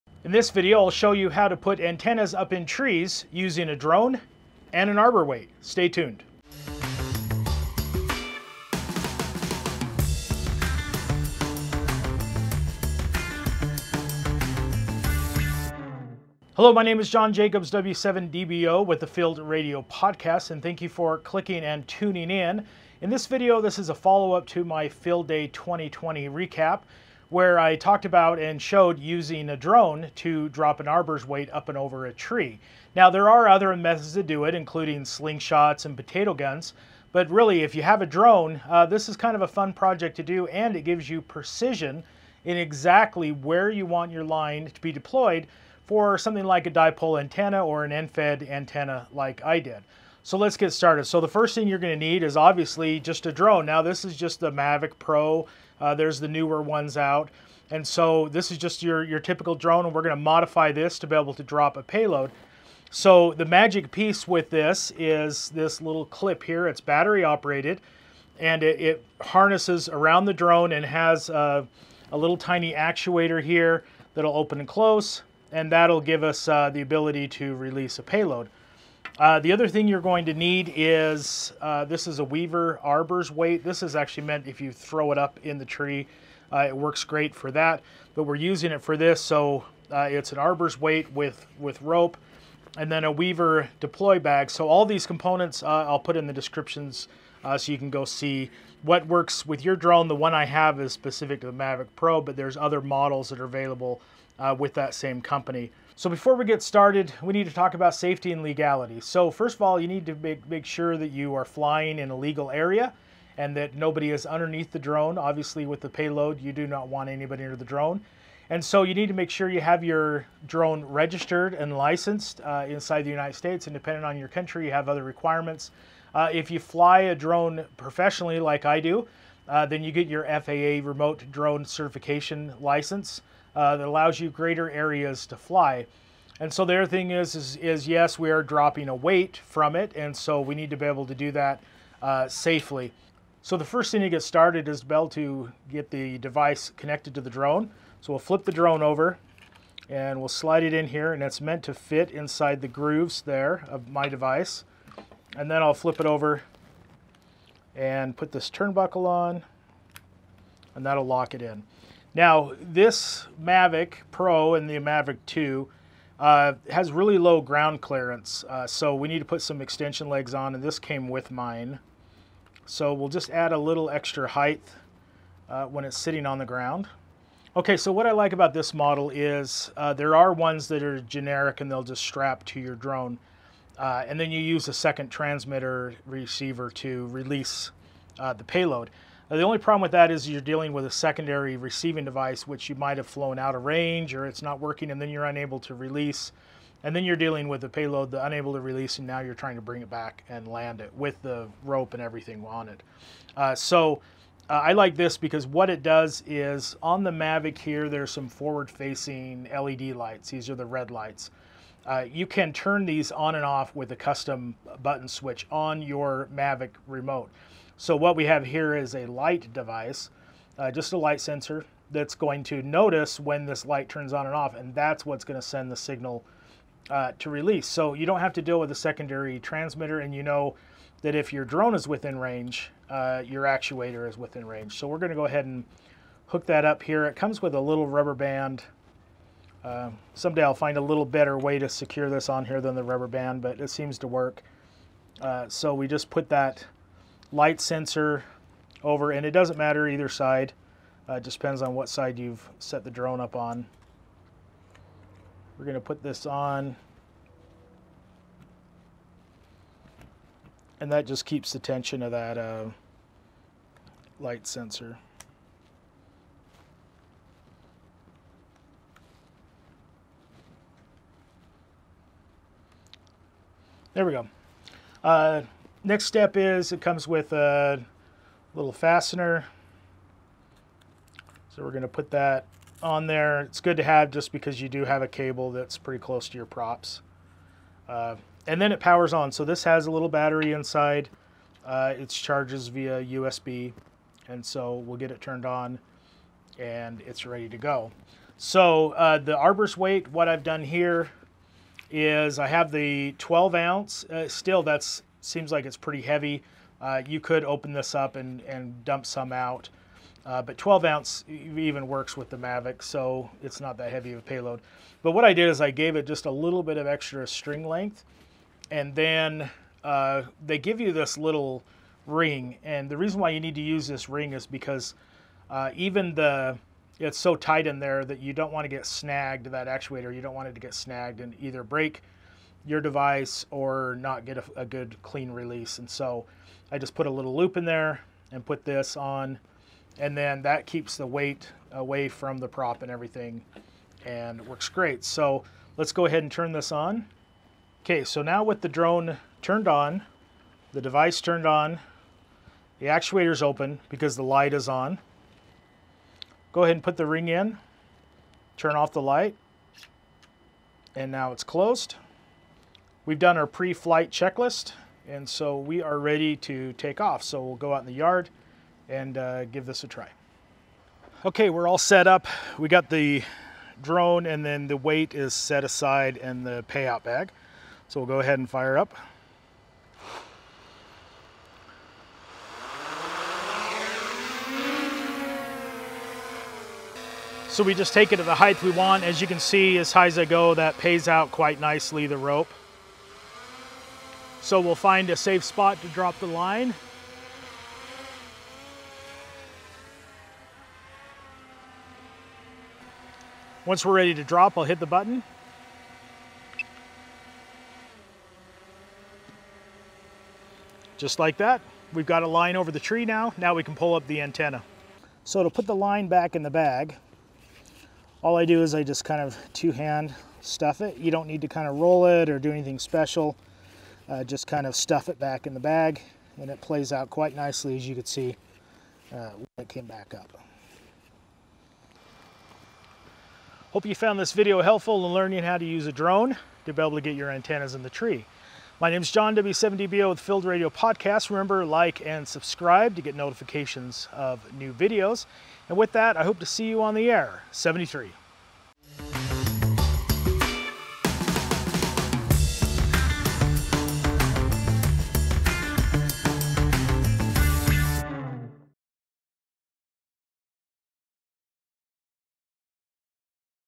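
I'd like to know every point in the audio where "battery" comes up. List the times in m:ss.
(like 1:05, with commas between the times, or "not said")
1:06, 4:50.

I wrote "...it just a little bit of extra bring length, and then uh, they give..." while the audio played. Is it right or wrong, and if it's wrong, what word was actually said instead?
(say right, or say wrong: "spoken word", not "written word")
wrong: "string", not "bring".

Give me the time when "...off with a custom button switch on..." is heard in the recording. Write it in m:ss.
3:33.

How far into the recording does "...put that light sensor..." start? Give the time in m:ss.
4:06.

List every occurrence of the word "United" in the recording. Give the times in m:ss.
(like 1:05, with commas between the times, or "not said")
2:03.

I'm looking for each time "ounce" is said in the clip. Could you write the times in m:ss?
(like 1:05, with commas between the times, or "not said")
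5:03, 5:10.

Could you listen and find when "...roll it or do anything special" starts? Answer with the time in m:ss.
7:01.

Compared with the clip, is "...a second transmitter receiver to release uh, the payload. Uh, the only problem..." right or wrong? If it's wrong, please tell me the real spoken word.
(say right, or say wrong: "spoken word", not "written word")
right.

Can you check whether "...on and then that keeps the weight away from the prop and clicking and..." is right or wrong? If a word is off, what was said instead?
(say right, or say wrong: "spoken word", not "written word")
wrong: "everything", not "clicking".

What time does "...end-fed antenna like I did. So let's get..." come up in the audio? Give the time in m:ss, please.
0:47.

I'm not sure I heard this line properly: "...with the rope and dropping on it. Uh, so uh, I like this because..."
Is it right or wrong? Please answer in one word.
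wrong.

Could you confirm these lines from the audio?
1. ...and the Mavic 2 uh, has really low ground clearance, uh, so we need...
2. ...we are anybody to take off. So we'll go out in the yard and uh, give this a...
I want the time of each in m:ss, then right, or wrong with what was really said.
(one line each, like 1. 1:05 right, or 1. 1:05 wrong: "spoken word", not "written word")
1. 2:44 right
2. 6:05 wrong: "ready", not "anybody".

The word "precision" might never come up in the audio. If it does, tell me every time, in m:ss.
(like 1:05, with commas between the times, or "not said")
0:41.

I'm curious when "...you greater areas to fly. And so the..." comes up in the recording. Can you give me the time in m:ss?
2:14.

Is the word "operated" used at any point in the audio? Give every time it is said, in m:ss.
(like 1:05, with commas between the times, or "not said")
1:07.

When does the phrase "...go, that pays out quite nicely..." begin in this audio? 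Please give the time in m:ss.
6:30.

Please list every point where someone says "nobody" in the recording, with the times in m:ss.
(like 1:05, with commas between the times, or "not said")
1:53.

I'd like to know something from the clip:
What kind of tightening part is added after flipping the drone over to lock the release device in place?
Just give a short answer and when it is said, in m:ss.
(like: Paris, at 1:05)
turnbuckle, at 2:38.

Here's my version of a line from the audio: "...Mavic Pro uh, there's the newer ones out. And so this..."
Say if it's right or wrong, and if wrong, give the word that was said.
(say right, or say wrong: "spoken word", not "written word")
right.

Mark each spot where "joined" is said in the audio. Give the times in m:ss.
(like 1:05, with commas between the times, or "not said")
not said.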